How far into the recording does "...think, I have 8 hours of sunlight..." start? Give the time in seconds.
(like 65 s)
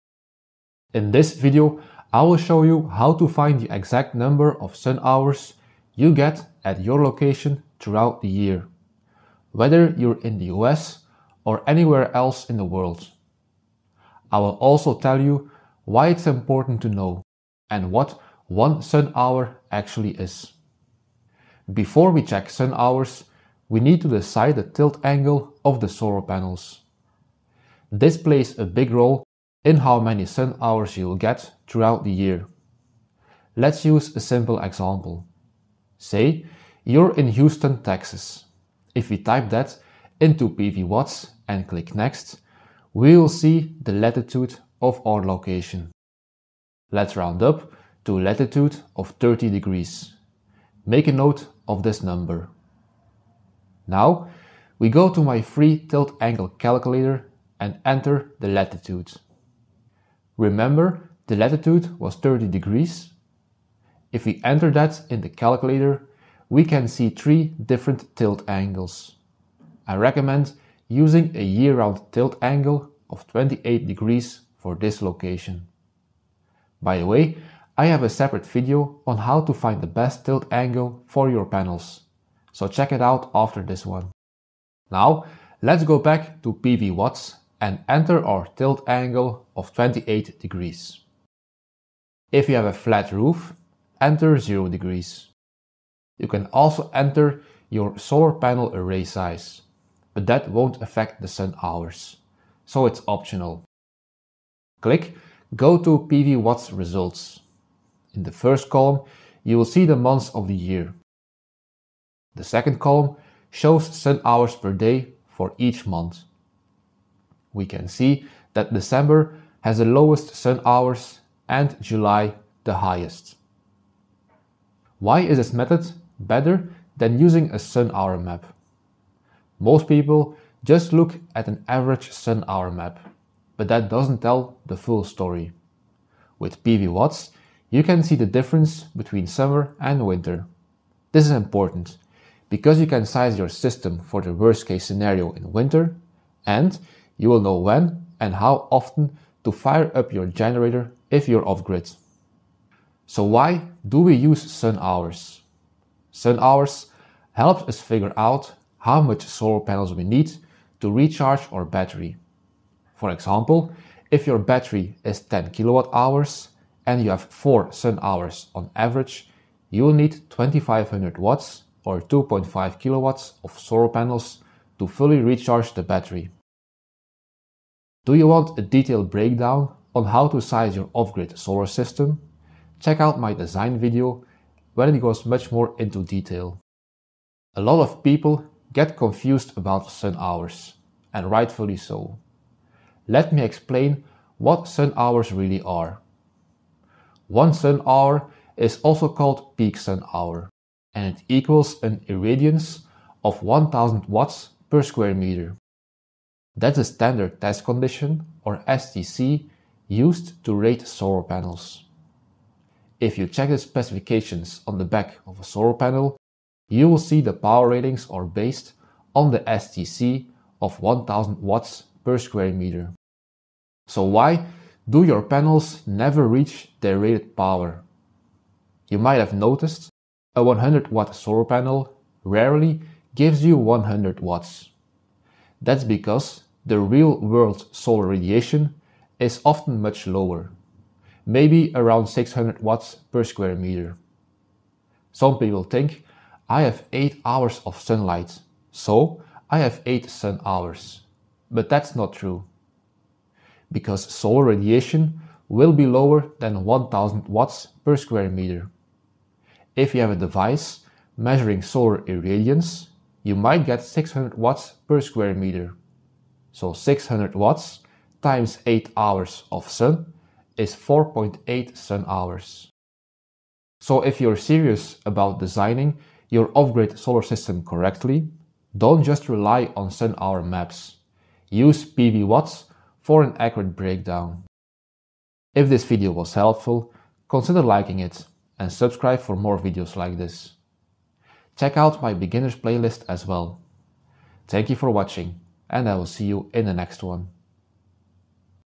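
245 s.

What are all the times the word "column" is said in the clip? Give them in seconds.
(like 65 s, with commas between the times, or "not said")
108 s, 112 s.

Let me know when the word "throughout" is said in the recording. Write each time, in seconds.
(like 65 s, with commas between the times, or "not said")
7 s, 31 s.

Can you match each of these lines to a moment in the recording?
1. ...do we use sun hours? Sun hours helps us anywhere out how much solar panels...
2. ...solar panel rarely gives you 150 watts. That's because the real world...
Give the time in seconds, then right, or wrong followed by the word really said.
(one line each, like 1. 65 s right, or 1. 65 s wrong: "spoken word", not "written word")
1. 153 s wrong: "figure", not "anywhere"
2. 231 s wrong: "100", not "150".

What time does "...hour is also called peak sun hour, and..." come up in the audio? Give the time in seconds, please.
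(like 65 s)
197 s.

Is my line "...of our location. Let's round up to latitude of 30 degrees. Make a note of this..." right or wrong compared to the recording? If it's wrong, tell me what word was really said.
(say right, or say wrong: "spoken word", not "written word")
right.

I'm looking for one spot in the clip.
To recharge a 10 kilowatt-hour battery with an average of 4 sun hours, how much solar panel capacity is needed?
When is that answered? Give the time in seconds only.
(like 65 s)
170 s.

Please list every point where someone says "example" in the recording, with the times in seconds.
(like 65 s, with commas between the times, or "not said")
34 s, 163 s.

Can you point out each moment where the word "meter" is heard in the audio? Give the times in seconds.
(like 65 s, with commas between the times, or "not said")
205 s, 222 s, 243 s, 258 s, 265 s.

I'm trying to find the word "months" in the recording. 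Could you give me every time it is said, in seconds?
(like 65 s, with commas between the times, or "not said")
109 s, 115 s.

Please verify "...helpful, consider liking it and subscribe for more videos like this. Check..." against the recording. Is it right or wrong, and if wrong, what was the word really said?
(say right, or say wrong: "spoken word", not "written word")
right.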